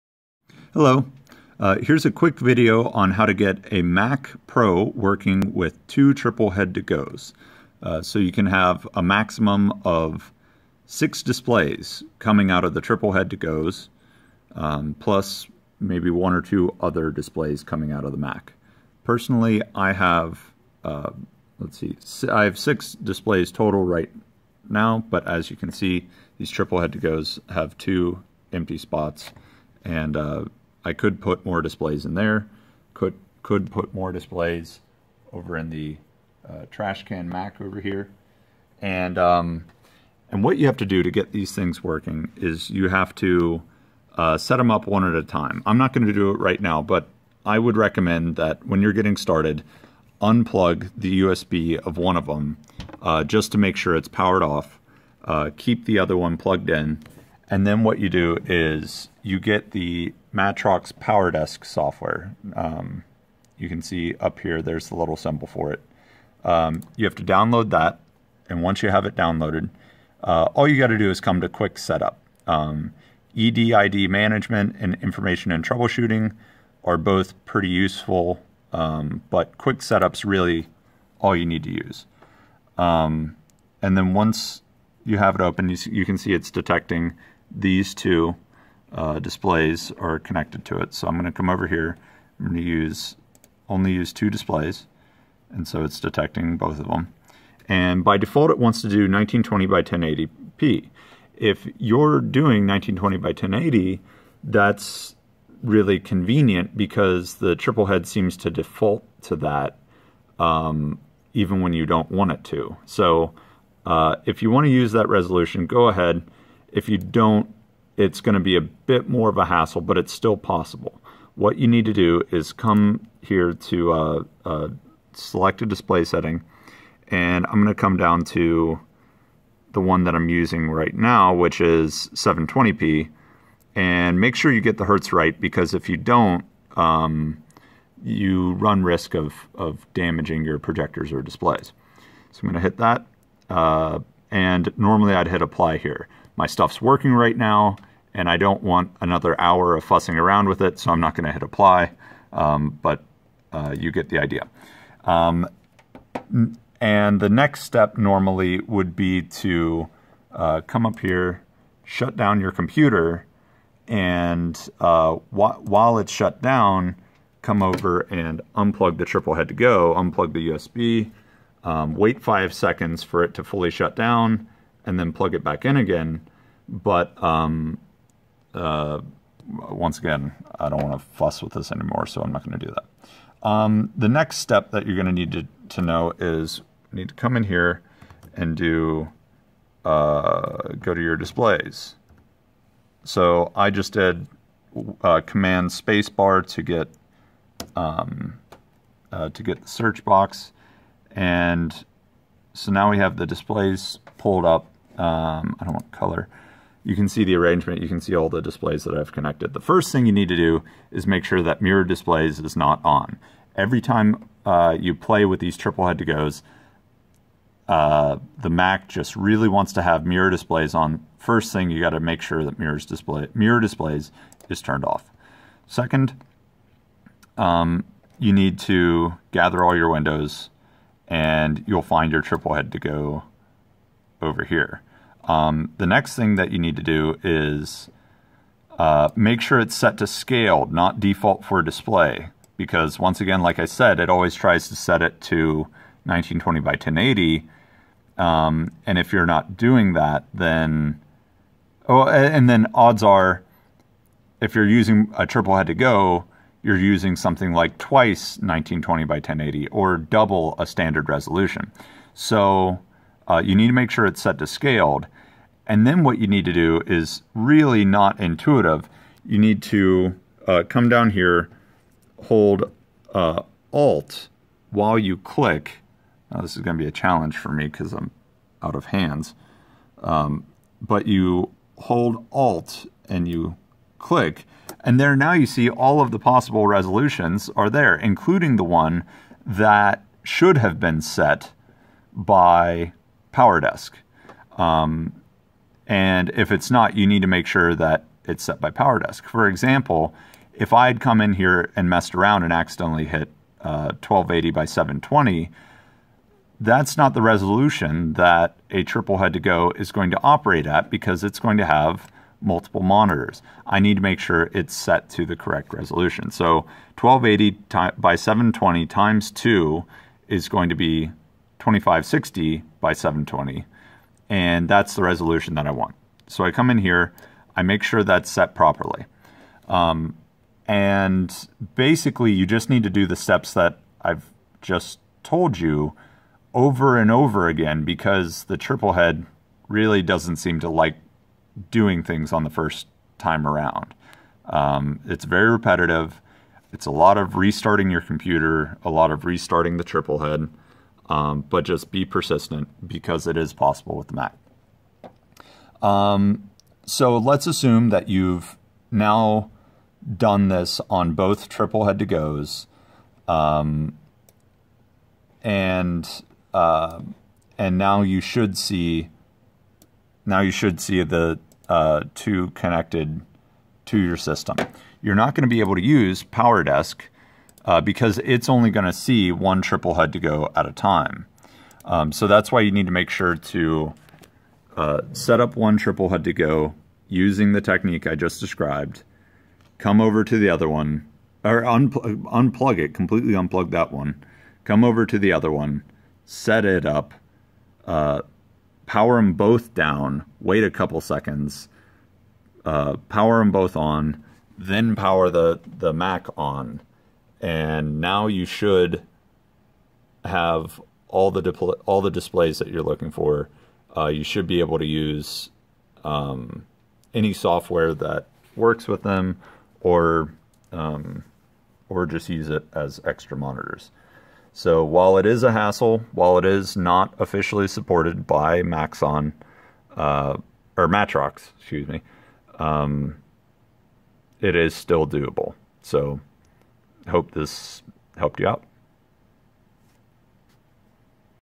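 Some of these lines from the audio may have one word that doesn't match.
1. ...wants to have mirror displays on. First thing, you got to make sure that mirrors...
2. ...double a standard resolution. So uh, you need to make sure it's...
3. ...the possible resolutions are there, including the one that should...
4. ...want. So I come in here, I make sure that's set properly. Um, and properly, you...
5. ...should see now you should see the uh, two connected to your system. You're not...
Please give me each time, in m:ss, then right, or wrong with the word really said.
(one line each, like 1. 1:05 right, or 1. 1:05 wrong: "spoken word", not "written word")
1. 3:39 right
2. 4:19 right
3. 4:46 right
4. 5:25 wrong: "basically", not "properly"
5. 6:08 right.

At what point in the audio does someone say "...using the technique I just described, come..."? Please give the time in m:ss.
6:27.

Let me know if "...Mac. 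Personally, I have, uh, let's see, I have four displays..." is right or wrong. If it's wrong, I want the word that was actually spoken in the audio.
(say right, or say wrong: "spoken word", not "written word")
wrong: "six", not "four".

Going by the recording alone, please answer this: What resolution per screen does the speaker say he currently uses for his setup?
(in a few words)
720p.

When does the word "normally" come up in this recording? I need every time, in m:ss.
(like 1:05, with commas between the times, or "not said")
2:24, 2:37.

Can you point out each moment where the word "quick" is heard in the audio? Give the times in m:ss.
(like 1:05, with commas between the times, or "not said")
0:02, 1:11, 1:19.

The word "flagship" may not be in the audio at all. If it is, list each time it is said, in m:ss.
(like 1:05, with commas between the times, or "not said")
not said.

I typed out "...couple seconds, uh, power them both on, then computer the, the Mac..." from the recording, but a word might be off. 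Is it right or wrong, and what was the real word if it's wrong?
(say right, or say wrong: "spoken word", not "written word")
wrong: "power", not "computer".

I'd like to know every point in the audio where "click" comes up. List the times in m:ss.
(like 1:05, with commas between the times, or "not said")
4:35, 4:43.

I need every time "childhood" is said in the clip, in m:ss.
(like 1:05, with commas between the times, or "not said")
not said.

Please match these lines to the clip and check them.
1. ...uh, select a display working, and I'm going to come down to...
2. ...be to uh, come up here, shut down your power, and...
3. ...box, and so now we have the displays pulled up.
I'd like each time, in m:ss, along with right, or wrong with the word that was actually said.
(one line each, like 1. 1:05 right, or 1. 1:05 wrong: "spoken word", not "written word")
1. 2:04 wrong: "setting", not "working"
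2. 2:38 wrong: "computer", not "power"
3. 3:20 right.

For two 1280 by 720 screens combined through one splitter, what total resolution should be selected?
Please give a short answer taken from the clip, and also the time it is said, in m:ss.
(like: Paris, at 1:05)
2560 by 720, at 5:21.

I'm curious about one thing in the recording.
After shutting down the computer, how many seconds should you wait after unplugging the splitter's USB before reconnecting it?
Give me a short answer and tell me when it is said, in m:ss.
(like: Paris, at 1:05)
5, at 2:52.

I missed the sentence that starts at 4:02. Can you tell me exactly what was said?
Because once again, like I said, it always tries to set it to 1920 by 1080.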